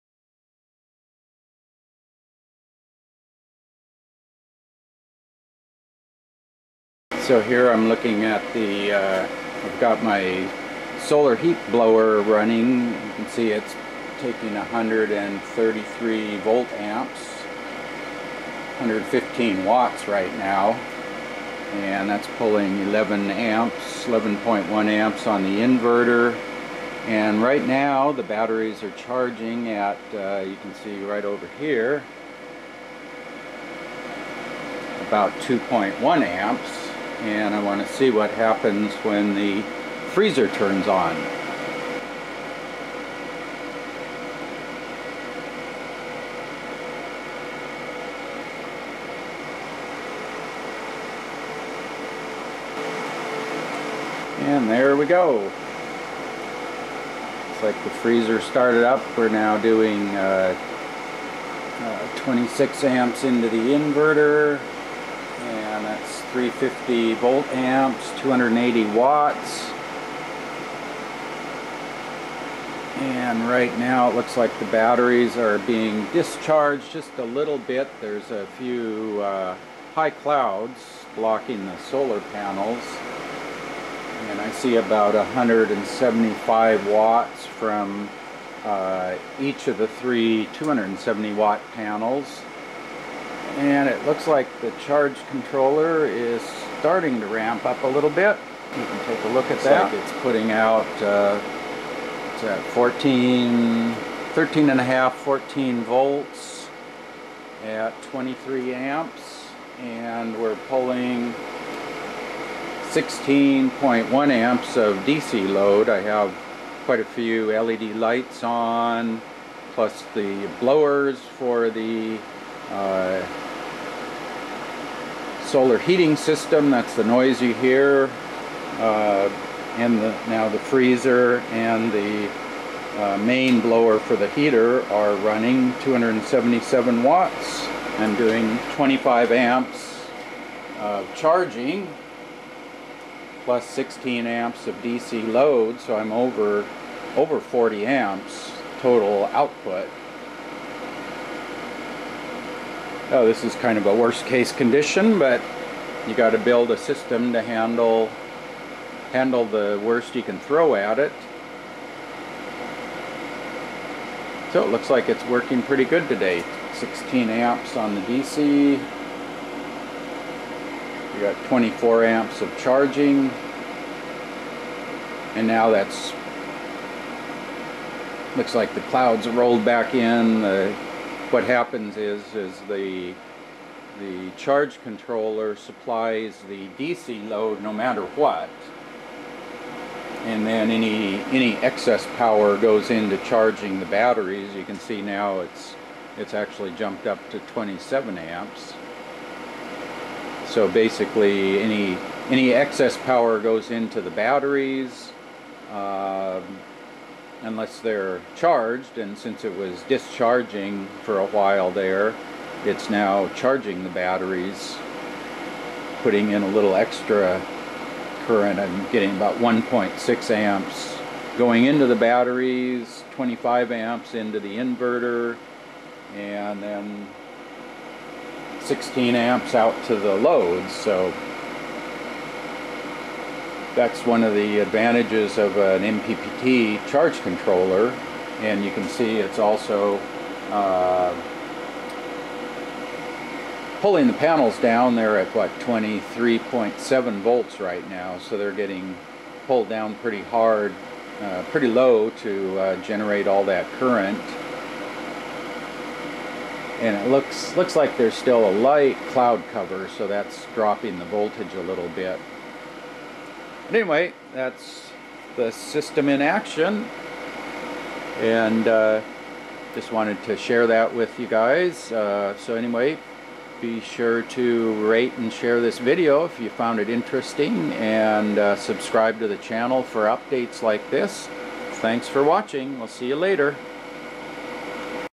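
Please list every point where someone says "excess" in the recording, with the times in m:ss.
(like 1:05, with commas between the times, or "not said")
3:11, 3:22.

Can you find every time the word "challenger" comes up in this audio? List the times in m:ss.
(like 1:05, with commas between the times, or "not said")
not said.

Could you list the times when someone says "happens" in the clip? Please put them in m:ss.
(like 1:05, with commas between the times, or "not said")
0:38, 3:01.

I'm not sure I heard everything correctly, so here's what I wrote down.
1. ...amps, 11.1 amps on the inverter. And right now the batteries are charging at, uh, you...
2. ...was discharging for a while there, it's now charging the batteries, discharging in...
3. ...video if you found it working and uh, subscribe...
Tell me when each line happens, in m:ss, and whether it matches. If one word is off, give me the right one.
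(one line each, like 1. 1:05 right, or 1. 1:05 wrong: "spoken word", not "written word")
1. 0:23 right
2. 3:29 wrong: "putting", not "discharging"
3. 4:35 wrong: "interesting", not "working".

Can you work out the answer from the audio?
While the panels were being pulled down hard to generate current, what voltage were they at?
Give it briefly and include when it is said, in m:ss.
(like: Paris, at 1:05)
23.7 volts, at 4:05.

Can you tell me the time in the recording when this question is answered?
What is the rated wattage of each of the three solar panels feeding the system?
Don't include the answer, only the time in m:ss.
1:30.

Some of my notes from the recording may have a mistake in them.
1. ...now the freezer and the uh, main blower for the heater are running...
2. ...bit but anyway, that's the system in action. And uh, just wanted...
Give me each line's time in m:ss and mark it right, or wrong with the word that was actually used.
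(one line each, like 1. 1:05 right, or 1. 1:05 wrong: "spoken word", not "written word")
1. 2:10 right
2. 4:21 right.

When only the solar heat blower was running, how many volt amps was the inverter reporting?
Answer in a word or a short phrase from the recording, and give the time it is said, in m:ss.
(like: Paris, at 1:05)
133, at 0:14.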